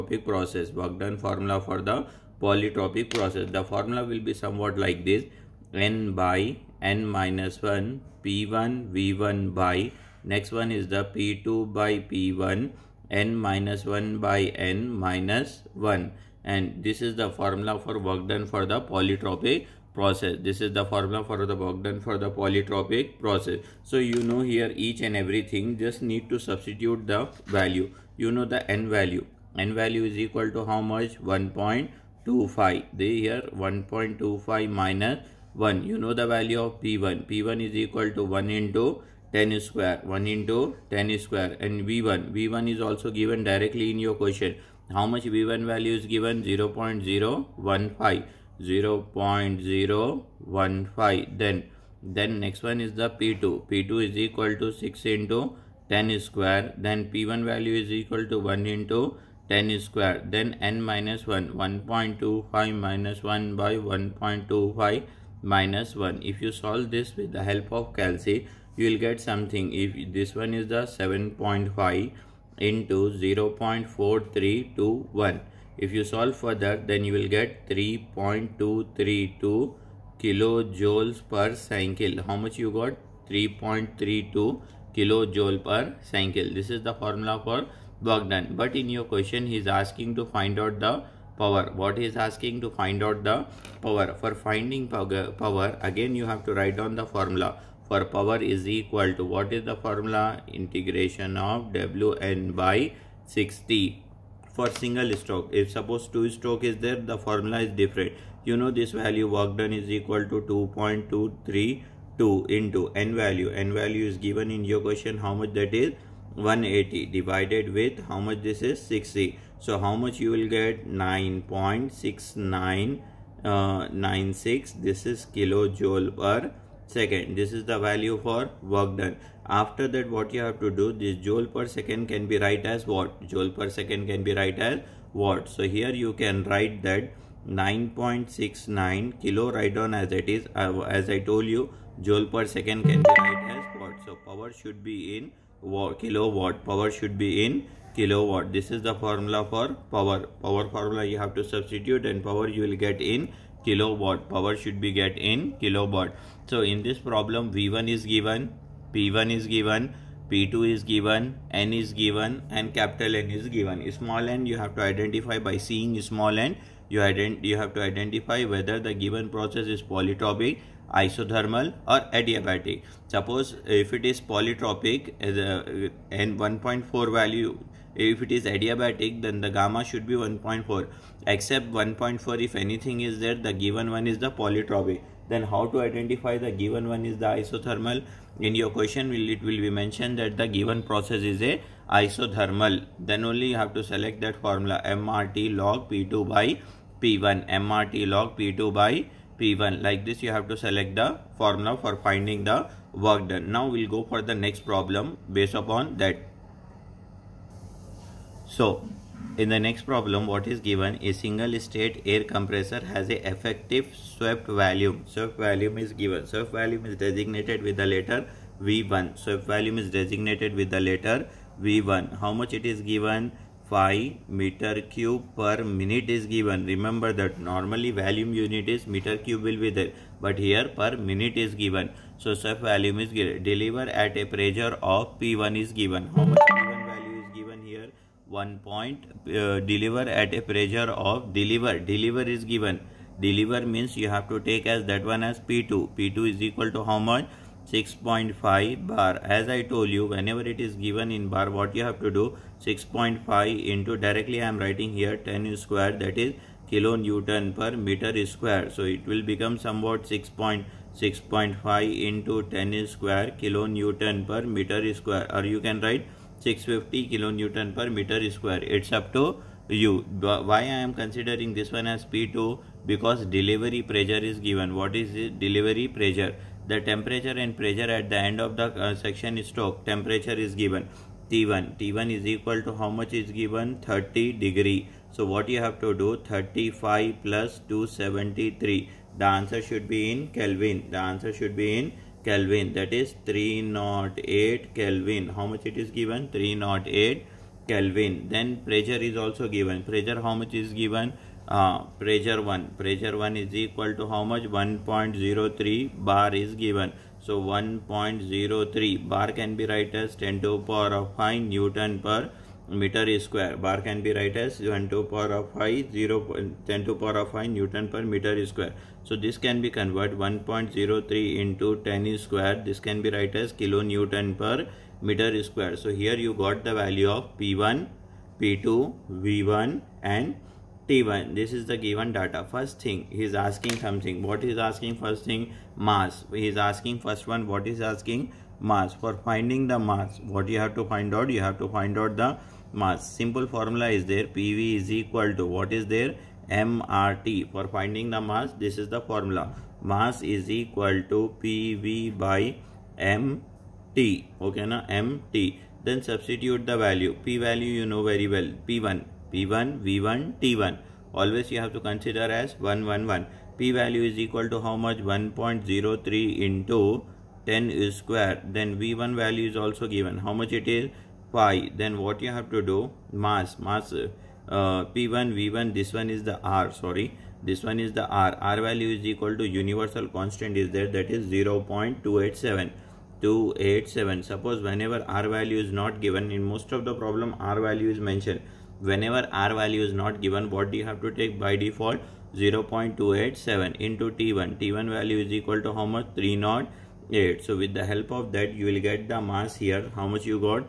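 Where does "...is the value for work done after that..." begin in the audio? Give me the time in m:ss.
2:07.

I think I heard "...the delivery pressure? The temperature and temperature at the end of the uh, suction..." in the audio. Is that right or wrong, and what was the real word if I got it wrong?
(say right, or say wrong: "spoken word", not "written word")
wrong: "pressure", not "temperature".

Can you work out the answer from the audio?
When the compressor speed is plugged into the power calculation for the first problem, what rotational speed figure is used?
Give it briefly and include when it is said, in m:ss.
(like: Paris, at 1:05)
180, at 1:55.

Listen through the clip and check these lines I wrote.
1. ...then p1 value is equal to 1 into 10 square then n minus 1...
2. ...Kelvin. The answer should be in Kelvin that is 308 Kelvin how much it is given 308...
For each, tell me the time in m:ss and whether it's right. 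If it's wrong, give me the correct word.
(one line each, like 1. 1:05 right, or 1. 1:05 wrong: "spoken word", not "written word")
1. 0:56 right
2. 4:50 right.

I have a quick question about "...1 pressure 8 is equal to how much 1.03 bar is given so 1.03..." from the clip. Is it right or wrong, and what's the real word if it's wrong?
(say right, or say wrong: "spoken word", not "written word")
wrong: "1", not "8".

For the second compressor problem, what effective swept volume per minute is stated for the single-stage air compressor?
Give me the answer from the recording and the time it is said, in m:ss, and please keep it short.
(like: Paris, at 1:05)
5 cubic meters per minute, at 3:43.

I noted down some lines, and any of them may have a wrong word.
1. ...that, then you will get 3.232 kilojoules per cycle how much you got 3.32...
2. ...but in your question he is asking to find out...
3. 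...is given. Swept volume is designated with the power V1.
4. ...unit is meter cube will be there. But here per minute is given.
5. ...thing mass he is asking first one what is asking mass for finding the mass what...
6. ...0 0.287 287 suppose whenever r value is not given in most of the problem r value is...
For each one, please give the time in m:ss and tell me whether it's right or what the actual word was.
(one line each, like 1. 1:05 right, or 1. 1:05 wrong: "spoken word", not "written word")
1. 1:16 right
2. 1:28 right
3. 3:35 wrong: "letter", not "power"
4. 3:48 right
5. 5:35 right
6. 6:21 right.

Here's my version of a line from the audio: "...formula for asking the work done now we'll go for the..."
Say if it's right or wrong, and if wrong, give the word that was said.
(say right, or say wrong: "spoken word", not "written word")
wrong: "finding", not "asking".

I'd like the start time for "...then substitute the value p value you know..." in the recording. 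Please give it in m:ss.
5:55.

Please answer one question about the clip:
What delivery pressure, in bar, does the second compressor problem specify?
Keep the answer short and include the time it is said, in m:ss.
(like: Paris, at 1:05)
6.5 bar, at 4:07.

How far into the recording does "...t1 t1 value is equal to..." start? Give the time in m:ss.
6:34.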